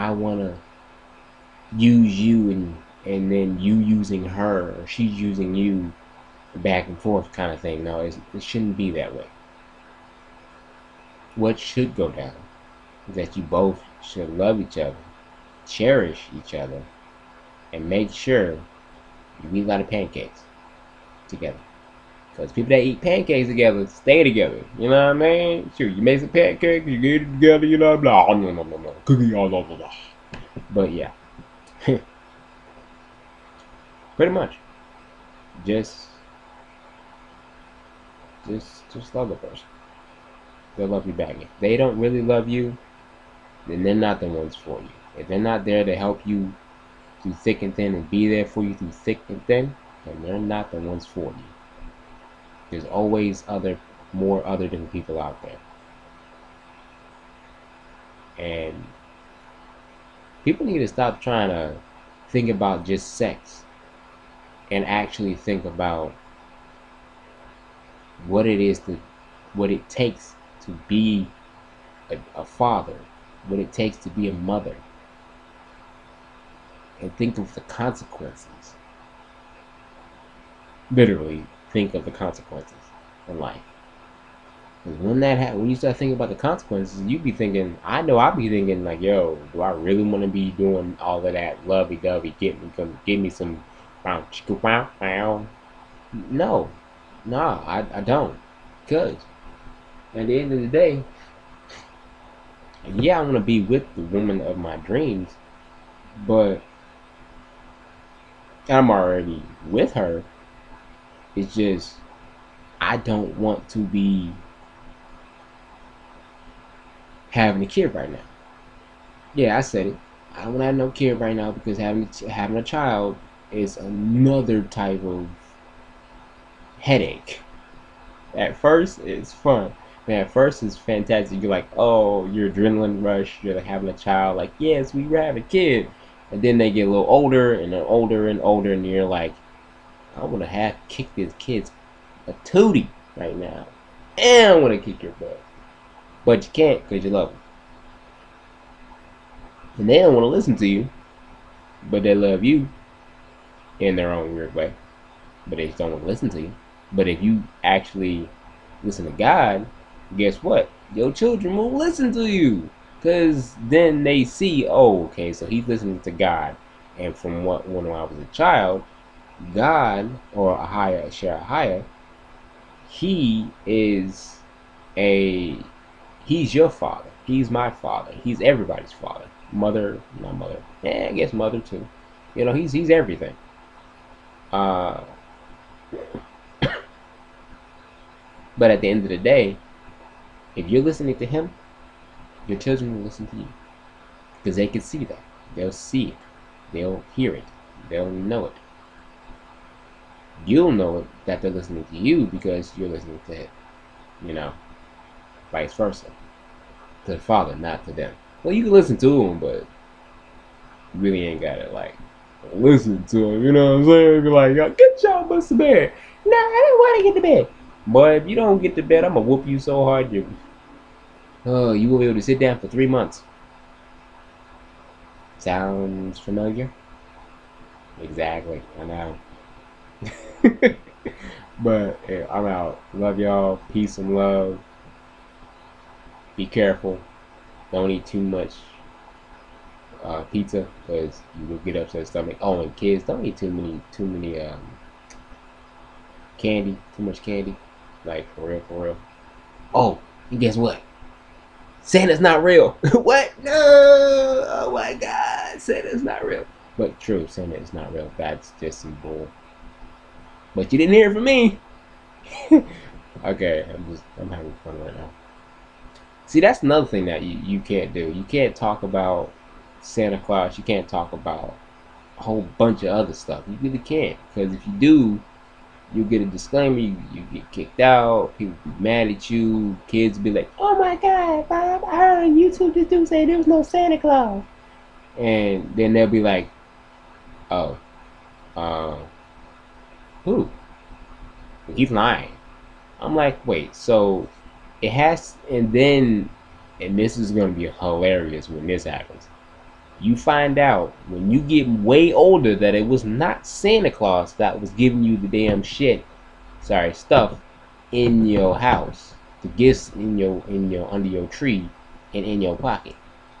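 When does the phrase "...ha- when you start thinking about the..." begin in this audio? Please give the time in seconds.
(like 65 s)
85 s.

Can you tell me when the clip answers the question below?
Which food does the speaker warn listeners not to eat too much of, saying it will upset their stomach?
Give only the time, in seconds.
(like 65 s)
240 s.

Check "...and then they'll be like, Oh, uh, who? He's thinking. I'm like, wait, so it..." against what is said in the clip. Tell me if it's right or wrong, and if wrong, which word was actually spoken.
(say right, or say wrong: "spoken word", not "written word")
wrong: "lying", not "thinking".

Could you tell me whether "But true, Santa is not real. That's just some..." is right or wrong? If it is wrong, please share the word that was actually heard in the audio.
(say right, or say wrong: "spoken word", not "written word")
right.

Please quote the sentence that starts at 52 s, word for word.
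There's always other, more other different people out there.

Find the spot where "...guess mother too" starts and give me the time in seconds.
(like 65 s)
181 s.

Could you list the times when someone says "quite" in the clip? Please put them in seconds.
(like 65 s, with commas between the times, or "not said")
not said.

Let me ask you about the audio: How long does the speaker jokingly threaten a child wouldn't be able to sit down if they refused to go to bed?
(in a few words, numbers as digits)
3 months.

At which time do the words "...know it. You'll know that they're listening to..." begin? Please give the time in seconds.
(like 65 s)
198 s.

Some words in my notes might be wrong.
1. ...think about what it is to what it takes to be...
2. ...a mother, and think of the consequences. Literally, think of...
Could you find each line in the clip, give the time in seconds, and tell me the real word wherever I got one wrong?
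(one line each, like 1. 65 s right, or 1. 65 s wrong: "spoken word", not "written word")
1. 65 s right
2. 74 s right.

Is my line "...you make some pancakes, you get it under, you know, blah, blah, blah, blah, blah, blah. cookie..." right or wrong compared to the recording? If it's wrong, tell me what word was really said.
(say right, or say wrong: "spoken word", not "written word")
wrong: "together", not "under".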